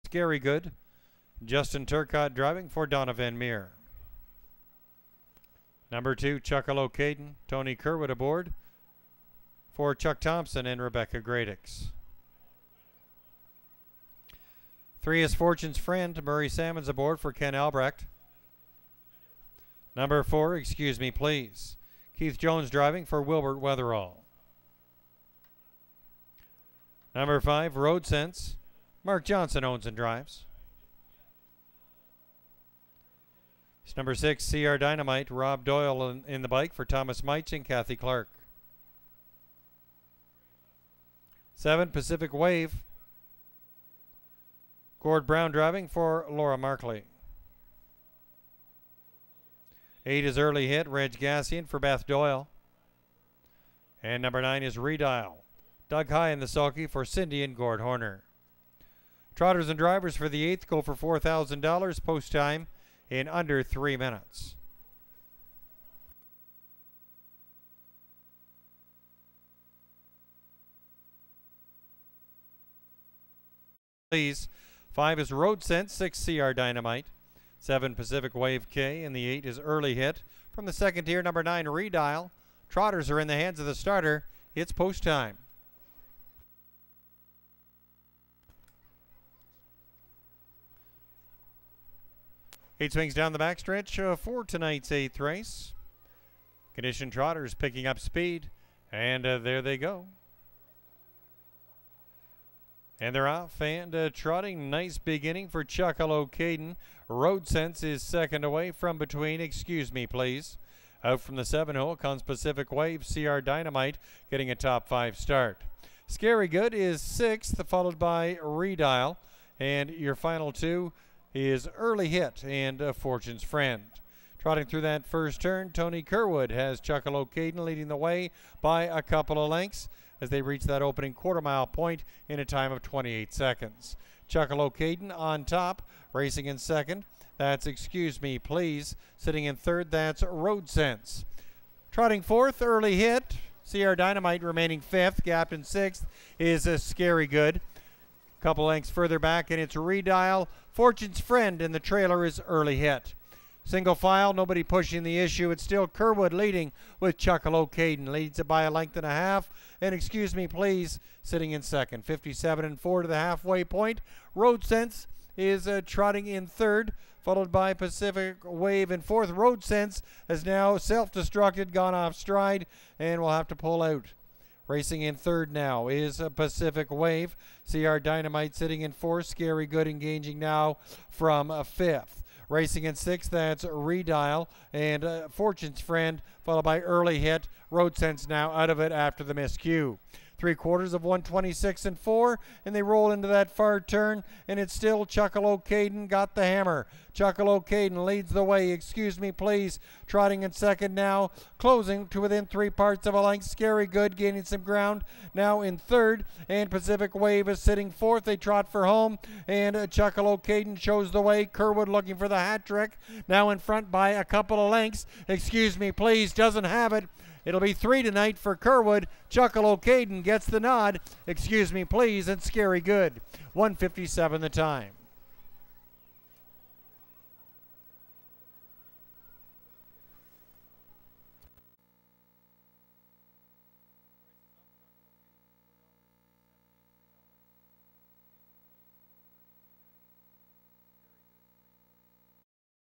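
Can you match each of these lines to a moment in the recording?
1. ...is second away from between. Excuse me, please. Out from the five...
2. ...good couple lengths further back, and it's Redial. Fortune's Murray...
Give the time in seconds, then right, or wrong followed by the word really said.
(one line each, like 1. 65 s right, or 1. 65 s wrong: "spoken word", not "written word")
1. 107 s wrong: "seven", not "five"
2. 147 s wrong: "Friend", not "Murray".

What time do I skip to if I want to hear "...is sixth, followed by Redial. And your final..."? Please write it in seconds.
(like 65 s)
116 s.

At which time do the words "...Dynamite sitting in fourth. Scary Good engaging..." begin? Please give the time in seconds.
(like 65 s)
177 s.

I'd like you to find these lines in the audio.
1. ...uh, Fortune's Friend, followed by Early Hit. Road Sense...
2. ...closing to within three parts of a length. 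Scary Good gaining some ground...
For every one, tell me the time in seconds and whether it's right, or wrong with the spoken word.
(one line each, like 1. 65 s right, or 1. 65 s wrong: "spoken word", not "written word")
1. 185 s right
2. 201 s right.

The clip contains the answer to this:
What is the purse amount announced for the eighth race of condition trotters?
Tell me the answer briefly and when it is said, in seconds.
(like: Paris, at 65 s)
$4,000, at 60 s.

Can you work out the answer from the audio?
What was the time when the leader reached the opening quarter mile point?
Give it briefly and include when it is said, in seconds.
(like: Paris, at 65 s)
28 seconds, at 132 s.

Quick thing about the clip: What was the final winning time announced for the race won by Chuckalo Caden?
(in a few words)
1:57.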